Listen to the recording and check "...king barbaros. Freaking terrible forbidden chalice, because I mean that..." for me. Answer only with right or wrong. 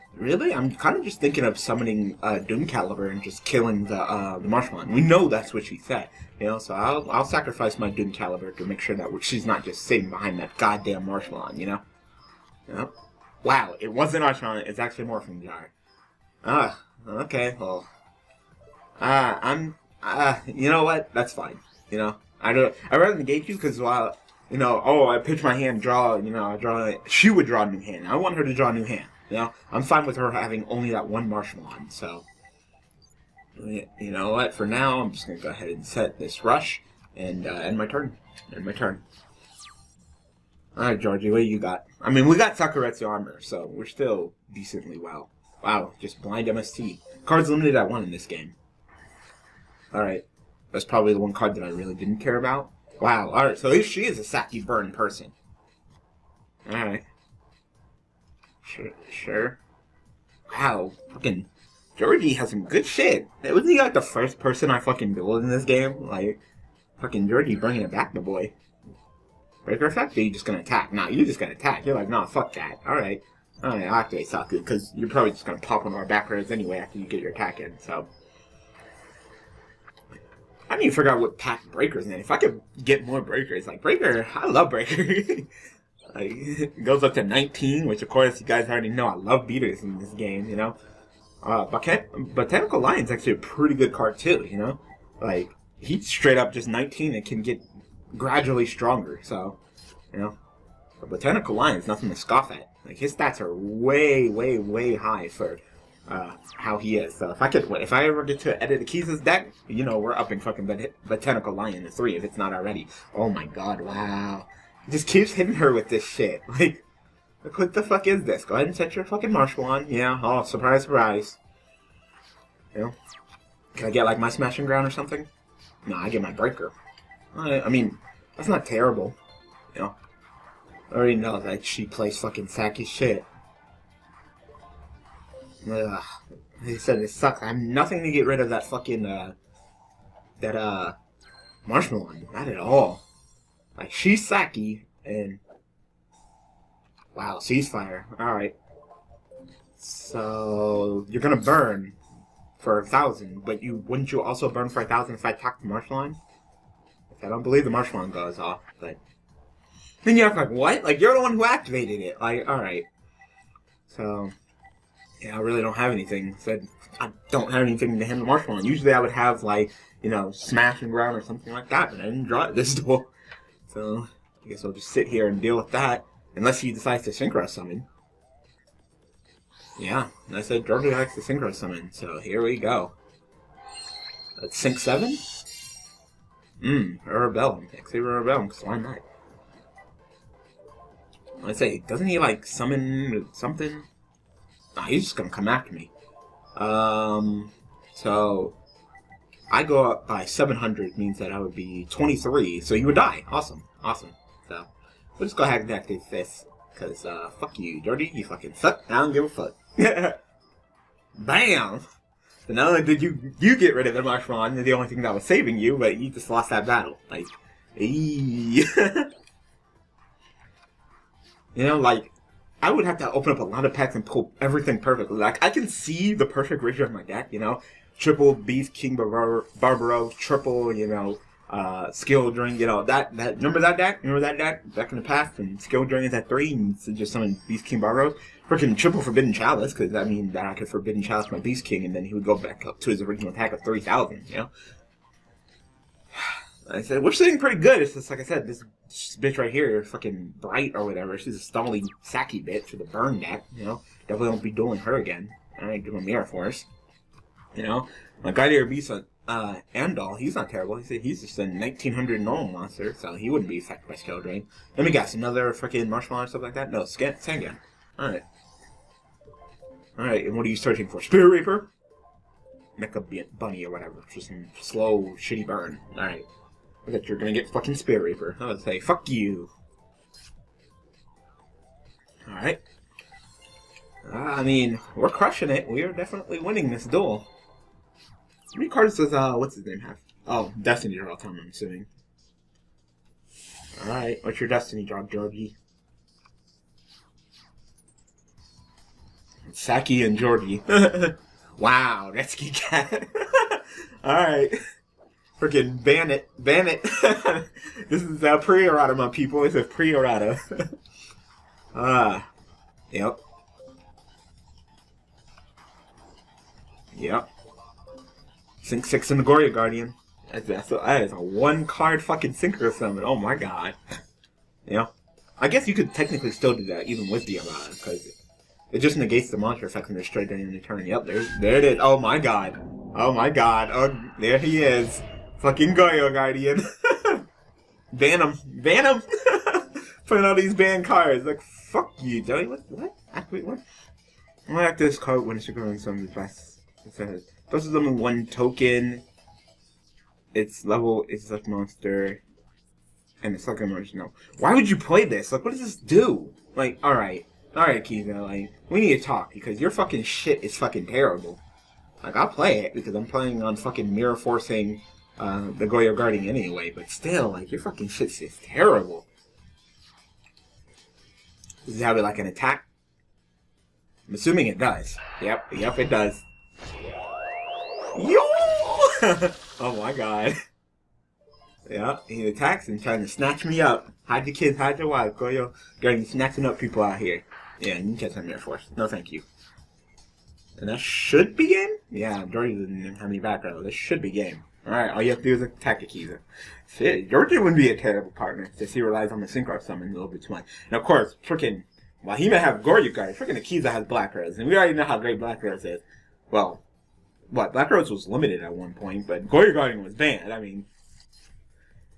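wrong.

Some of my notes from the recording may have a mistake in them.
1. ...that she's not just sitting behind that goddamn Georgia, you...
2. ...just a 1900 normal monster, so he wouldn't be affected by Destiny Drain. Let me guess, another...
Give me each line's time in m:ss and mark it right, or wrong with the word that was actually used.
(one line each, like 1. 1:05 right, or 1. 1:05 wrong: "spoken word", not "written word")
1. 0:08 wrong: "Marshmallow", not "Georgia"
2. 4:21 wrong: "Skill", not "Destiny".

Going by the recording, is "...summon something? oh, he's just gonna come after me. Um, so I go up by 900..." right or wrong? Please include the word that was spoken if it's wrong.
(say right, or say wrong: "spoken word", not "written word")
wrong: "700", not "900".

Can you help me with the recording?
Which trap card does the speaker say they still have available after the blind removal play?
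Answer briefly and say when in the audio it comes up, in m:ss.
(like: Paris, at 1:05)
Sakuretsu Armor, at 0:42.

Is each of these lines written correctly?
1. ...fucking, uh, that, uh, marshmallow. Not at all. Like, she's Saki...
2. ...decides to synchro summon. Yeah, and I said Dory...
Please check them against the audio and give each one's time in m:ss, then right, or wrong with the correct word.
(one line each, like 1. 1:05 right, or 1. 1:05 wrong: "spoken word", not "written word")
1. 2:18 right
2. 2:56 wrong: "Georgia", not "Dory".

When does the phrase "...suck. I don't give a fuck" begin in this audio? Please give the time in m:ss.
3:28.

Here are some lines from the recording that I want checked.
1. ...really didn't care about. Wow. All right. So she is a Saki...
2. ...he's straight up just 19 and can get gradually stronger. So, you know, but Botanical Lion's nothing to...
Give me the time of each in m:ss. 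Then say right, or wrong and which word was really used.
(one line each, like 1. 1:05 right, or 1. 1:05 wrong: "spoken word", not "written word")
1. 0:51 right
2. 1:35 right.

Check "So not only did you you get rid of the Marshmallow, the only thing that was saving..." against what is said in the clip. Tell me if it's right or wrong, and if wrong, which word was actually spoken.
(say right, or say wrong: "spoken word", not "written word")
right.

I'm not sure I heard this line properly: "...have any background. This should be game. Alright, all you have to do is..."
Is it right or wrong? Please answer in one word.
right.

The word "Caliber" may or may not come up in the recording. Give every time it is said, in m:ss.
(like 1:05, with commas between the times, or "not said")
0:02, 0:08.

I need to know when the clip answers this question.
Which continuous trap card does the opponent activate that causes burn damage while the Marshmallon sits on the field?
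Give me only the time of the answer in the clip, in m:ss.
2:27.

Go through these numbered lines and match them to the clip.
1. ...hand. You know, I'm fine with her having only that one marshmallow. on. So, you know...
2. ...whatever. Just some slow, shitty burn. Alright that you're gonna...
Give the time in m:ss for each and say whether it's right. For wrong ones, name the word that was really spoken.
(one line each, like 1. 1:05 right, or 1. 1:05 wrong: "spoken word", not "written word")
1. 0:28 right
2. 4:33 right.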